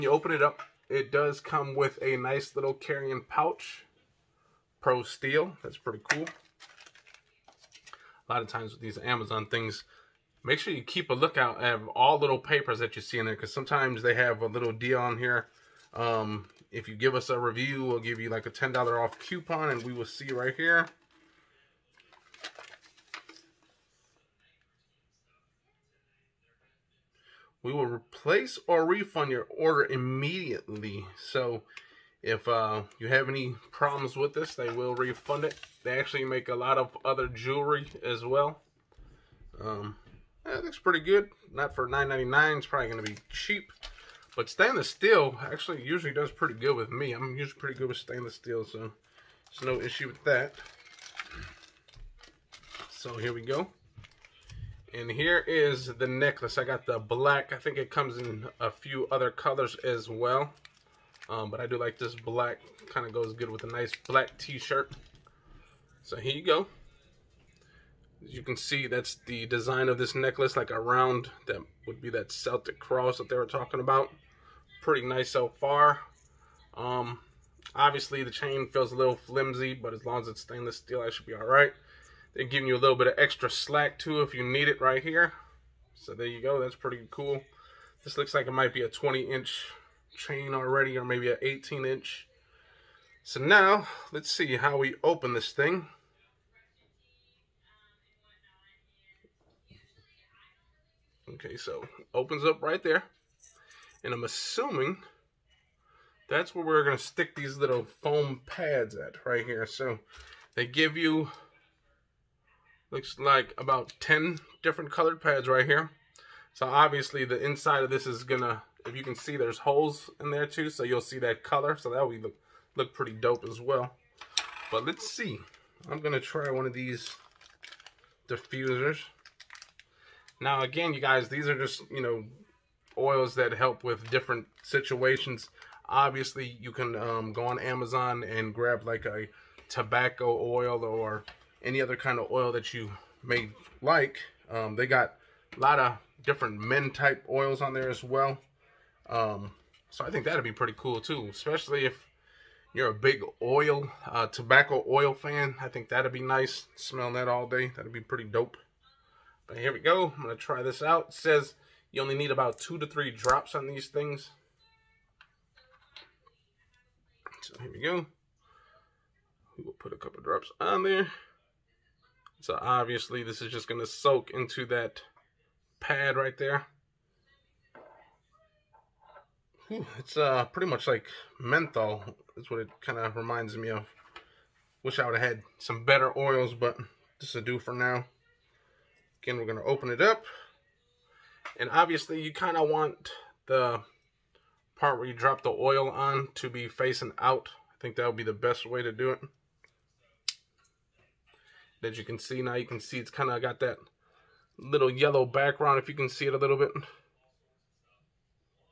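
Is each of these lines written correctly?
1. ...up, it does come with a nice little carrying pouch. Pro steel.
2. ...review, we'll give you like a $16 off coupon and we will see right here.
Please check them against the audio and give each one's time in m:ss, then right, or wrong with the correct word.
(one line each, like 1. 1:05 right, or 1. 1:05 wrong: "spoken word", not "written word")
1. 0:00 right
2. 0:17 wrong: "10", not "16".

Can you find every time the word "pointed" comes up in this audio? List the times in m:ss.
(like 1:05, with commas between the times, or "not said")
not said.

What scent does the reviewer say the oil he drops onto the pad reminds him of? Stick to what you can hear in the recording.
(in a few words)
Menthol.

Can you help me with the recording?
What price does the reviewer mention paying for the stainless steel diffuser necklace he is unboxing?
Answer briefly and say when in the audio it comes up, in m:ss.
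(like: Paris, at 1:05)
$9.99, at 0:41.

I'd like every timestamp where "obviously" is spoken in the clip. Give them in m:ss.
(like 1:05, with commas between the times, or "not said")
1:17, 1:56, 2:15, 2:52, 3:11.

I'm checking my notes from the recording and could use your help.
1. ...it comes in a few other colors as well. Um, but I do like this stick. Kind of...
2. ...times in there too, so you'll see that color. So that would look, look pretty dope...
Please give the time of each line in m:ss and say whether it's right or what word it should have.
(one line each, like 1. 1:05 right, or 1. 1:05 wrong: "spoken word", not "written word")
1. 0:57 wrong: "black", not "stick"
2. 1:59 wrong: "holes", not "times".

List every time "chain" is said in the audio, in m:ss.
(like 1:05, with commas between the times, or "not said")
1:18, 1:30.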